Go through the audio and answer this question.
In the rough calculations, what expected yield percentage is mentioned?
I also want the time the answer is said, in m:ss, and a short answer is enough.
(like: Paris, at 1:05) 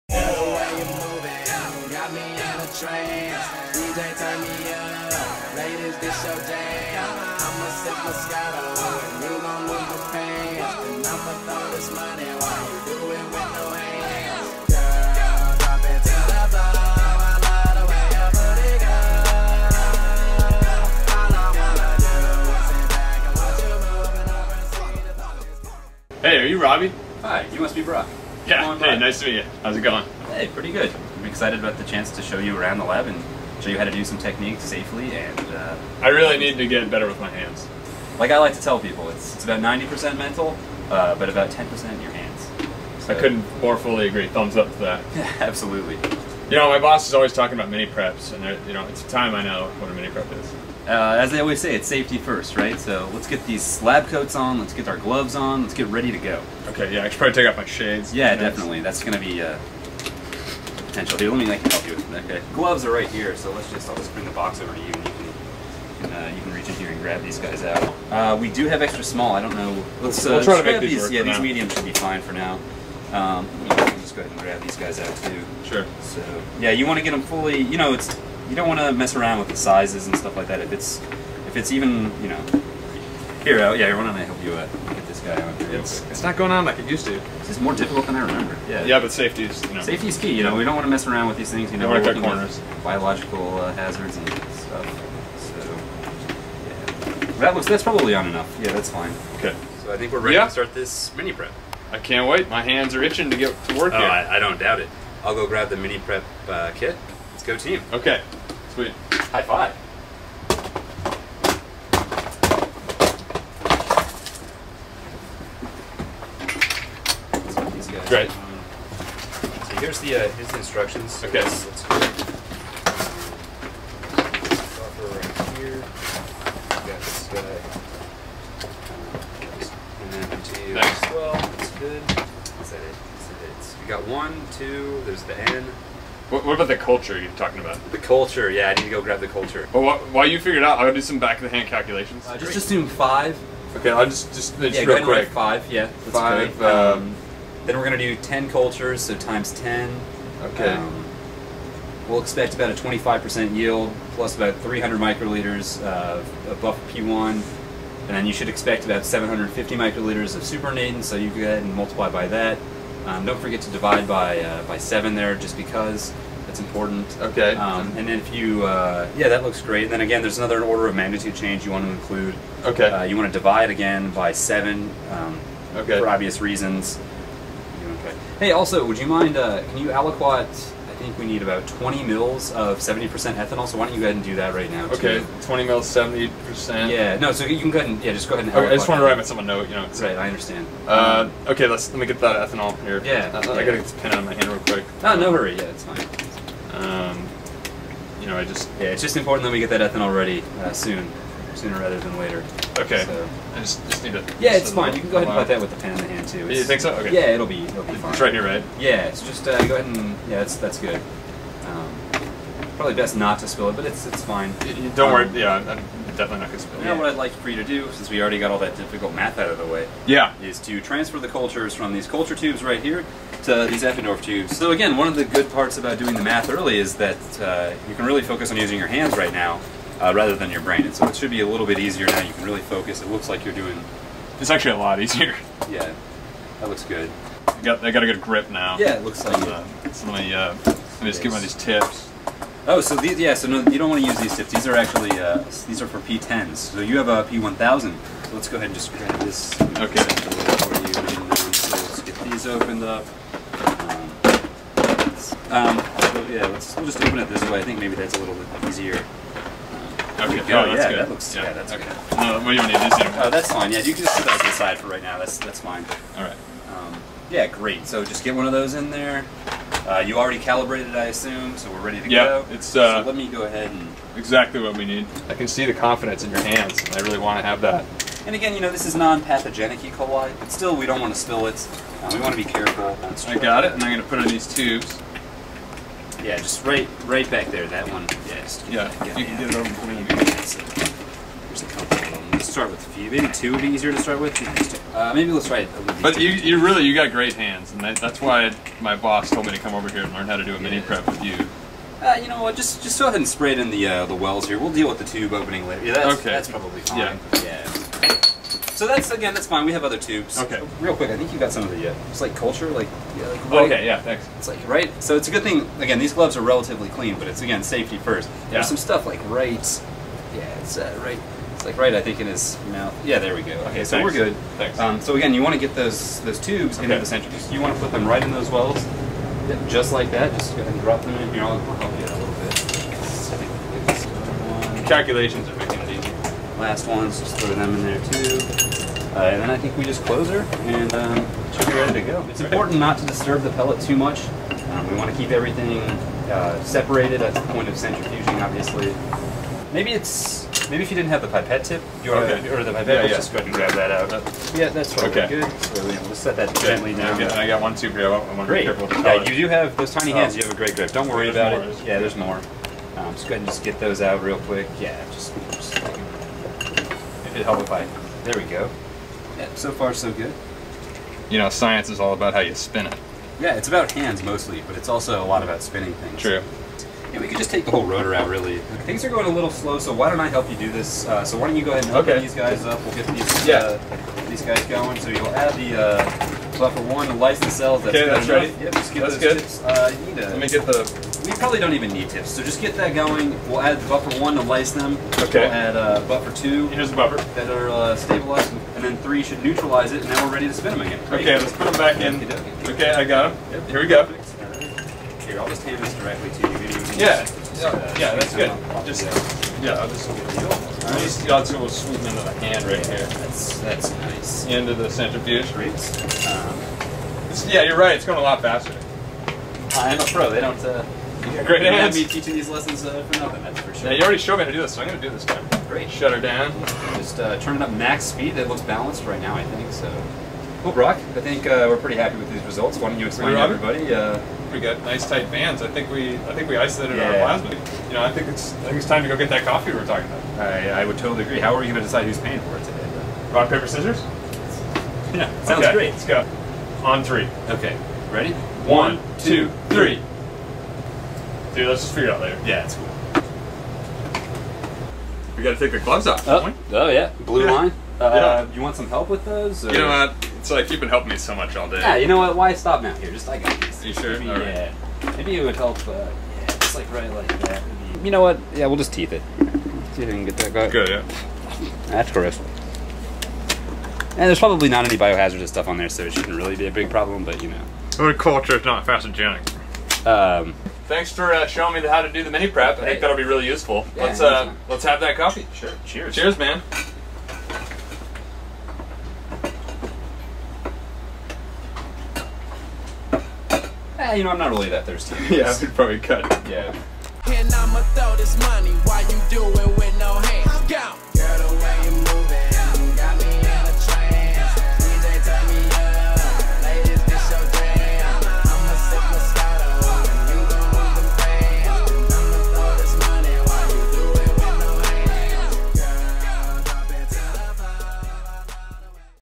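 25%, at 2:32.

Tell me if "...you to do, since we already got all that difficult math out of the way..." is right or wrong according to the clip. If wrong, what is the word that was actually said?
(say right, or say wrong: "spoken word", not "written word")
right.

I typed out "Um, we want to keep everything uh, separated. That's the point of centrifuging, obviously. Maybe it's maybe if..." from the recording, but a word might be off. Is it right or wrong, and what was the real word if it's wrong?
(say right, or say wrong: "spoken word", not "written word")
right.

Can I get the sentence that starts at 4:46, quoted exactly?
Yeah, just right right back there, that one.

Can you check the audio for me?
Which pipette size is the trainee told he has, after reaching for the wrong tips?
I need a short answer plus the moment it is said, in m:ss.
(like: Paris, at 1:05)
P1000, at 4:07.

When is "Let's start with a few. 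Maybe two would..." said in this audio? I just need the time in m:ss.
4:52.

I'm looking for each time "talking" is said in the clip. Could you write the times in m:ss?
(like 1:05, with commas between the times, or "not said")
0:47, 2:17, 7:19.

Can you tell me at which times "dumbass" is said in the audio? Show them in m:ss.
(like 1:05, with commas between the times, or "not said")
not said.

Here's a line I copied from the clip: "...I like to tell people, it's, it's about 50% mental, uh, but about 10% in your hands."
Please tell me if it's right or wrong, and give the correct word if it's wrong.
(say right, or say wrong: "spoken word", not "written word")
wrong: "90", not "50".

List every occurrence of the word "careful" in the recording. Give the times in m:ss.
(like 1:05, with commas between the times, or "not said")
4:42, 5:58.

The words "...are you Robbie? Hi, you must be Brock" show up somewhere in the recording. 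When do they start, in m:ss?
0:26.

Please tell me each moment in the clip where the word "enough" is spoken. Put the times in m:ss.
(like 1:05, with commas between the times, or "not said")
1:38, 6:28.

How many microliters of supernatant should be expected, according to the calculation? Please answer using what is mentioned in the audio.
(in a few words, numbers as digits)
750.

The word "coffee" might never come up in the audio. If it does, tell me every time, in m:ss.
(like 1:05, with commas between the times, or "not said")
7:19, 8:05.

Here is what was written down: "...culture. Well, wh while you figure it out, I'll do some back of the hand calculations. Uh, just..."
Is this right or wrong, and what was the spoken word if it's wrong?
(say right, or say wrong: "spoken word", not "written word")
right.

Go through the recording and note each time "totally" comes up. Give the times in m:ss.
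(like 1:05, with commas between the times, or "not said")
5:54, 7:20.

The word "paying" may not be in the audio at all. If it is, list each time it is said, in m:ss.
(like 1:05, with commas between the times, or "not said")
7:22.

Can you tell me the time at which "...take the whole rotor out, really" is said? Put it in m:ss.
6:17.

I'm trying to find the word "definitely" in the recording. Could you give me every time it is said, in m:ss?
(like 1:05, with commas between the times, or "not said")
0:58, 3:36.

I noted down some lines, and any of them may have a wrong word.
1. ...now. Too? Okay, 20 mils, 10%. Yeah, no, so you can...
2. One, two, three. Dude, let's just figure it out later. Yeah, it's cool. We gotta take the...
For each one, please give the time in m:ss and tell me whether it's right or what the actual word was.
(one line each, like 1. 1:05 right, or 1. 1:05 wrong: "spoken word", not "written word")
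1. 3:04 wrong: "70", not "10"
2. 7:28 right.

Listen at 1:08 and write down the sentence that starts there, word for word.
Uh, we do have extra small.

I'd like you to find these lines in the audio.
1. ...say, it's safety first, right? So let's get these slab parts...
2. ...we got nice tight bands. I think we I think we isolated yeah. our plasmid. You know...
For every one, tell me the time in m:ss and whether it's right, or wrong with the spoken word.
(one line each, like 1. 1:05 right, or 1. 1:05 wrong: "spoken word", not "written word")
1. 0:51 wrong: "coats", not "parts"
2. 7:14 right.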